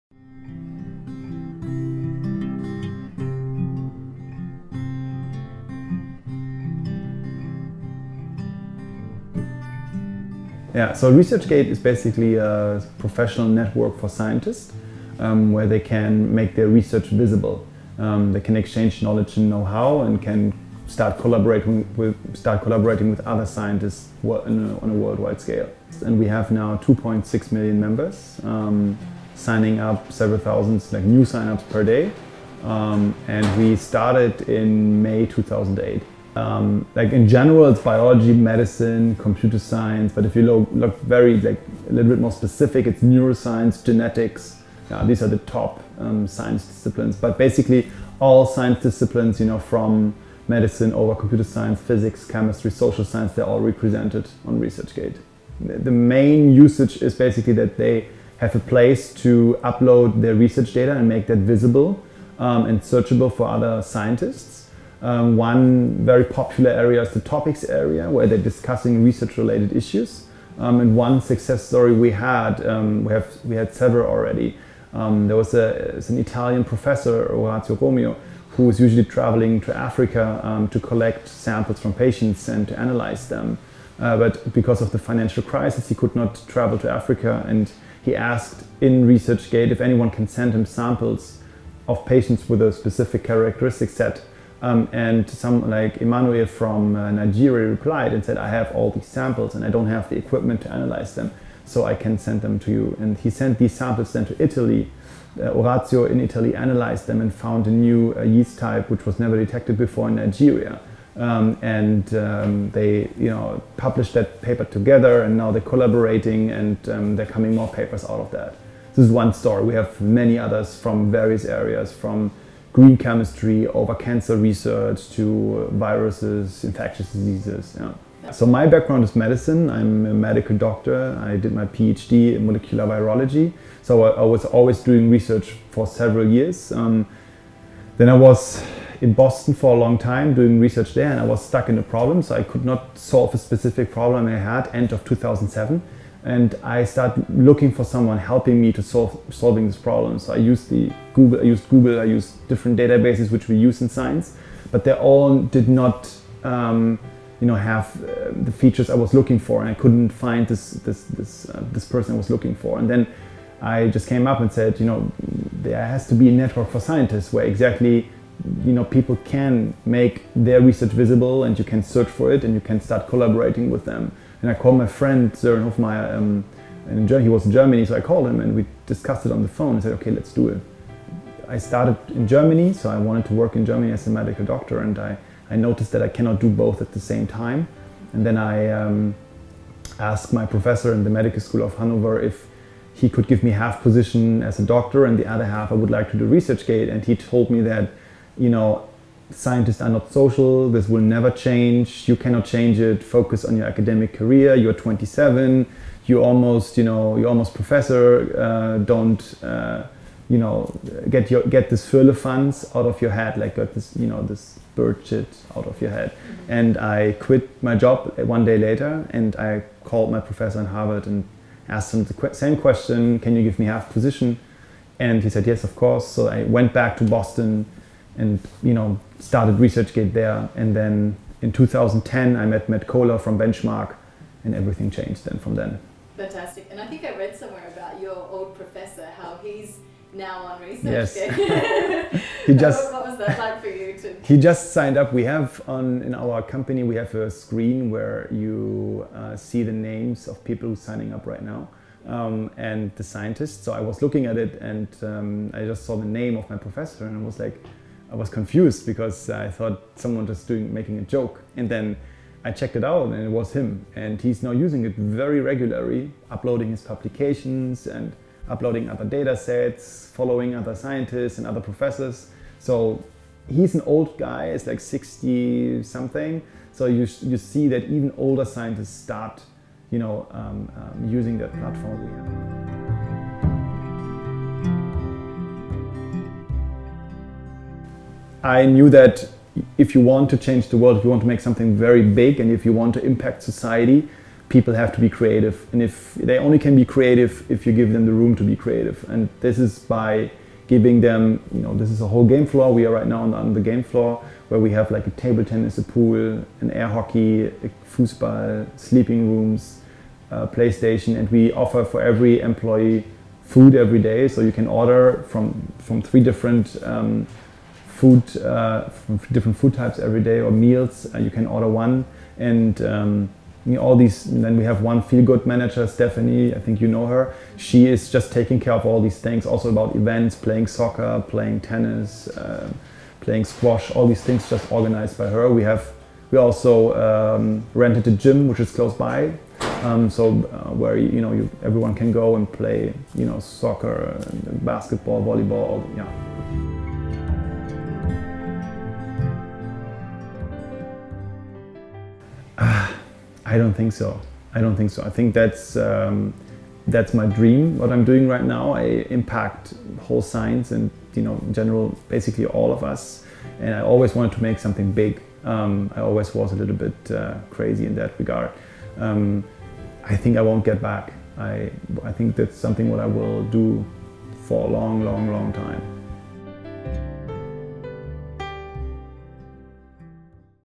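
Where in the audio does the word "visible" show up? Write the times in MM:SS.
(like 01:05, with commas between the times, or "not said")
00:17, 01:01, 02:50.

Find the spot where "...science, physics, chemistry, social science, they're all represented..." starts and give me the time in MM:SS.
00:51.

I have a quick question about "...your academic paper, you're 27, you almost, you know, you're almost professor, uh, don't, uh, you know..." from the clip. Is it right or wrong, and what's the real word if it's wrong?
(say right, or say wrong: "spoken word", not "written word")
wrong: "career", not "paper".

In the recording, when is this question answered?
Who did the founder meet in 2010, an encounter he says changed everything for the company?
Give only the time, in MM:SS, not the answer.
03:52.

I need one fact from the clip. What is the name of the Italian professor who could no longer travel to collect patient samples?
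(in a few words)
Orazio Romeo.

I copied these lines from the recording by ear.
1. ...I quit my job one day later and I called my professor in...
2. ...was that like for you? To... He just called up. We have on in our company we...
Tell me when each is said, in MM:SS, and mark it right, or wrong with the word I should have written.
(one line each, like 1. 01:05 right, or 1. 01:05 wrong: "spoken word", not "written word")
1. 03:36 right
2. 04:03 wrong: "signed", not "called".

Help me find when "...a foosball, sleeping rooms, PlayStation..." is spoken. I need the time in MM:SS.
05:07.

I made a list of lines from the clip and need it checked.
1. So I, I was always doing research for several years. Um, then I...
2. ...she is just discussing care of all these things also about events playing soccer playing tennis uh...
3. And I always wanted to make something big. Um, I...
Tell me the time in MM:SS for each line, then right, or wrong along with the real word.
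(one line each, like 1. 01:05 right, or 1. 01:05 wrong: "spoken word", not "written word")
1. 02:13 right
2. 05:27 wrong: "taking", not "discussing"
3. 06:03 right.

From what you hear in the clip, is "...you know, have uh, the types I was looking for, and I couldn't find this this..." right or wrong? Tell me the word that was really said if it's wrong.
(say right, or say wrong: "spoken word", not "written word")
wrong: "features", not "types".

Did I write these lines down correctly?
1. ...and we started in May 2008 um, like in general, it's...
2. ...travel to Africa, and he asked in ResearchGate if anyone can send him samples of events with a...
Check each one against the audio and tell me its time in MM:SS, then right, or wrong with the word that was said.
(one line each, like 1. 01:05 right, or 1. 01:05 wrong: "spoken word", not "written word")
1. 00:33 right
2. 01:26 wrong: "patients", not "events".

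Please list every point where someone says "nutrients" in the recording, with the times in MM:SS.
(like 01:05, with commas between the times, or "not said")
not said.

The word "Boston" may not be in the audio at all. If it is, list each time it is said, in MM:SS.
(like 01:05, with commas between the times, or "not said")
02:19, 03:47.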